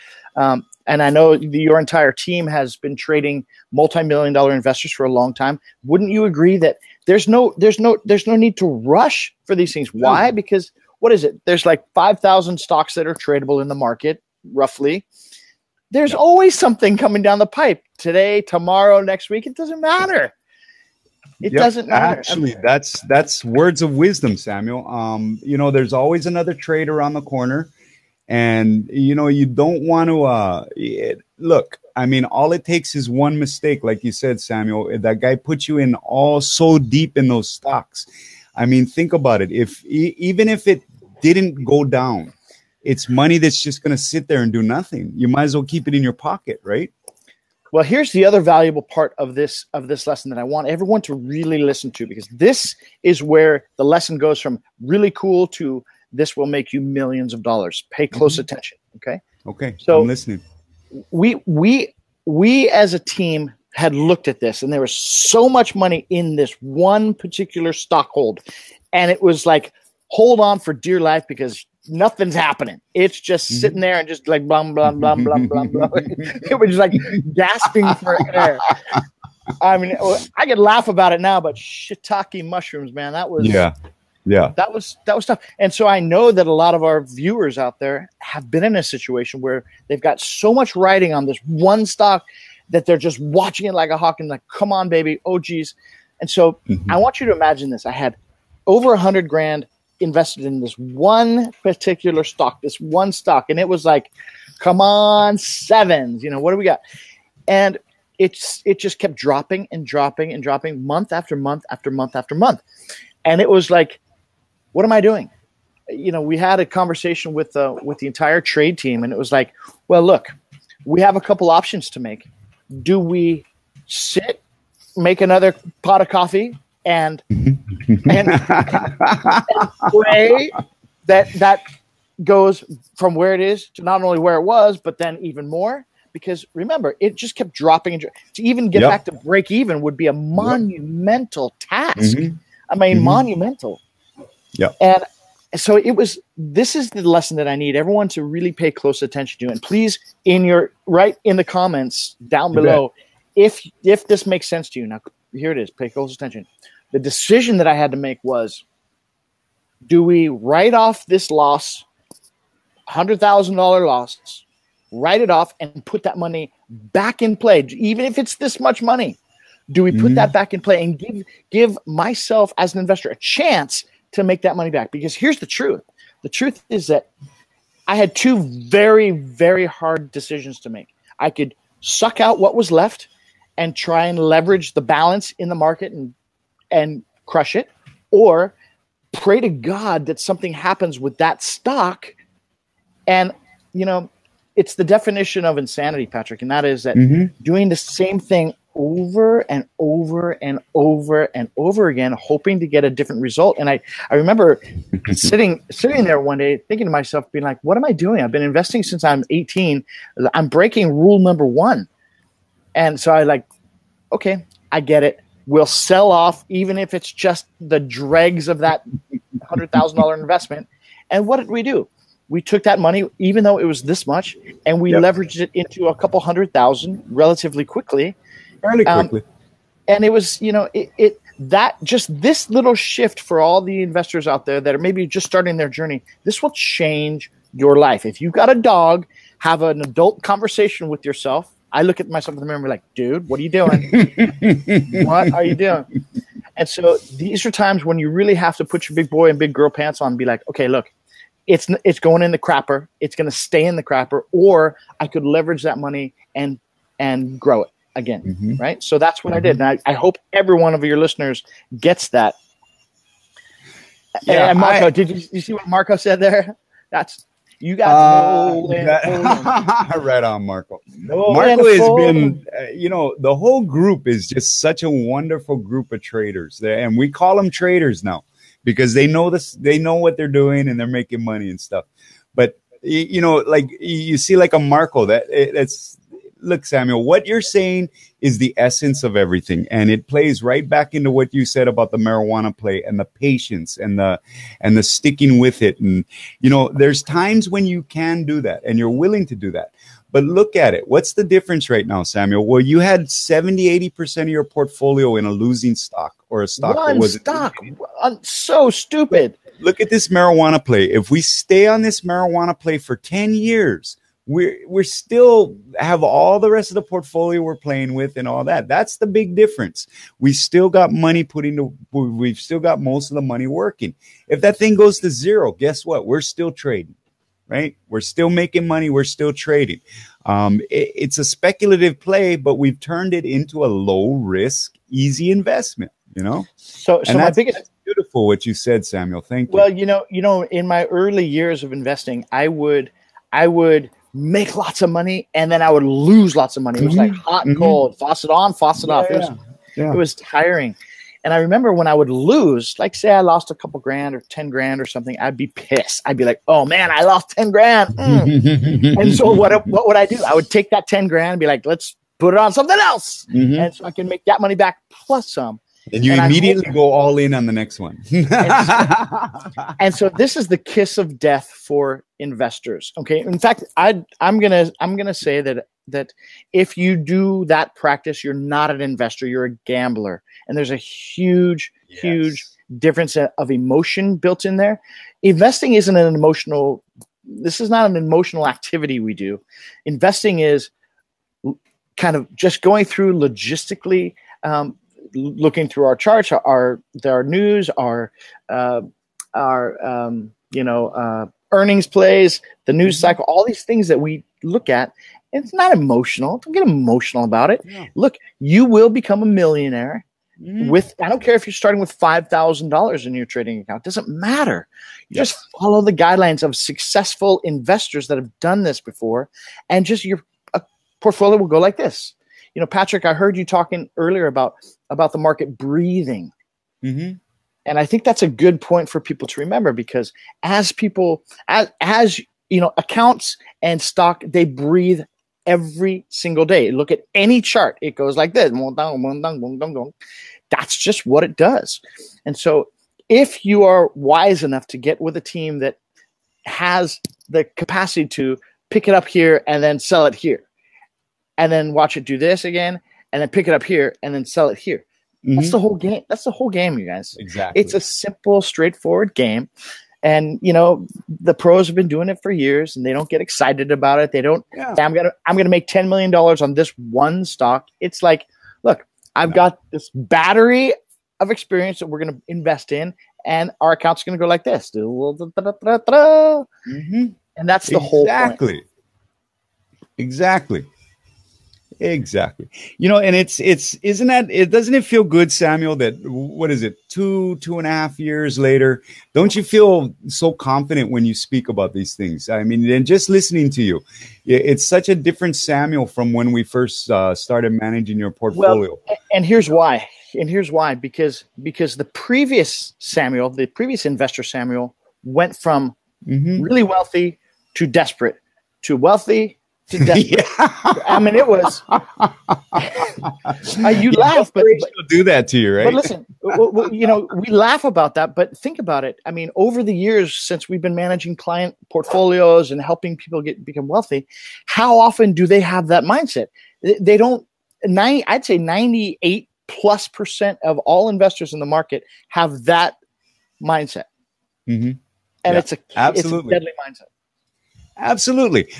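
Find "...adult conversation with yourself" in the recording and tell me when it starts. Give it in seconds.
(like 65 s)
239 s.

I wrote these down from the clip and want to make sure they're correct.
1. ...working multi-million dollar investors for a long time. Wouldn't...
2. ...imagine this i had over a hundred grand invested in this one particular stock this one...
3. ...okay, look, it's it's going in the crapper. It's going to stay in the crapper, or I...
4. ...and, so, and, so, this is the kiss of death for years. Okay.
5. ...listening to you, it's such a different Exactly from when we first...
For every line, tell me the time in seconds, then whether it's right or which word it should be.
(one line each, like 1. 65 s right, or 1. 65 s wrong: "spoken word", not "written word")
1. 2 s wrong: "trading", not "working"
2. 97 s right
3. 250 s right
4. 368 s wrong: "investors", not "years"
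5. 493 s wrong: "Samuel", not "Exactly".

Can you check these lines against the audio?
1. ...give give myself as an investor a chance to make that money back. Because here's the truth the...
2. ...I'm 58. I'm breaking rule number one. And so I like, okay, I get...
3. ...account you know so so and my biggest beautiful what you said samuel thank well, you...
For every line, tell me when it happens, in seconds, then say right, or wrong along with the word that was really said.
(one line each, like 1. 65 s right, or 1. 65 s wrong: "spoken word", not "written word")
1. 170 s right
2. 209 s wrong: "18", not "58"
3. 335 s wrong: "investment", not "account".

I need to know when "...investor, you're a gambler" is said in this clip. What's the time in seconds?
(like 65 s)
378 s.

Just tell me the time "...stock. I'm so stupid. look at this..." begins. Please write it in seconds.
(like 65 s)
307 s.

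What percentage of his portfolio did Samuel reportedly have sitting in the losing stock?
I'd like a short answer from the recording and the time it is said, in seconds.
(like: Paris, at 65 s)
70-80%, at 303 s.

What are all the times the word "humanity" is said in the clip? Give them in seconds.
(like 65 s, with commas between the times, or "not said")
not said.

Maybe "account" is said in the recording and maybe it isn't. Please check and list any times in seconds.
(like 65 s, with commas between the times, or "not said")
413 s, 432 s, 473 s.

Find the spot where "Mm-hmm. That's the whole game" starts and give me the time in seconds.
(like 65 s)
455 s.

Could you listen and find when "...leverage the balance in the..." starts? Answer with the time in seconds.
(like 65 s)
184 s.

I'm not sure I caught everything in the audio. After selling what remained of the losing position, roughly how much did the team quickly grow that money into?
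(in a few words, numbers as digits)
a couple hundred thousand.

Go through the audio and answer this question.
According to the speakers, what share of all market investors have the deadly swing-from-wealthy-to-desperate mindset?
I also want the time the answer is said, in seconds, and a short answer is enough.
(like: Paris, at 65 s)
98+%, at 528 s.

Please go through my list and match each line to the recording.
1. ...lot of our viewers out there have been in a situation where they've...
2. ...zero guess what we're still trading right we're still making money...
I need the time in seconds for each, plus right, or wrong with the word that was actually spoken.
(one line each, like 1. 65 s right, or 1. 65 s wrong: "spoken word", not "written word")
1. 86 s right
2. 325 s right.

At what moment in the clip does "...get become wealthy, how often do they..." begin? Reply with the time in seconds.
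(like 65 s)
523 s.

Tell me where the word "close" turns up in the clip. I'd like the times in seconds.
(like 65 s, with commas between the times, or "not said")
58 s, 148 s, 155 s.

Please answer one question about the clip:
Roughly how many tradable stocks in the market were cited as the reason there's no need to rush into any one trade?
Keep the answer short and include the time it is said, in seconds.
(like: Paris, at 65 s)
5,000, at 11 s.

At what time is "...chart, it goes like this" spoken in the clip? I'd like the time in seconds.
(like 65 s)
437 s.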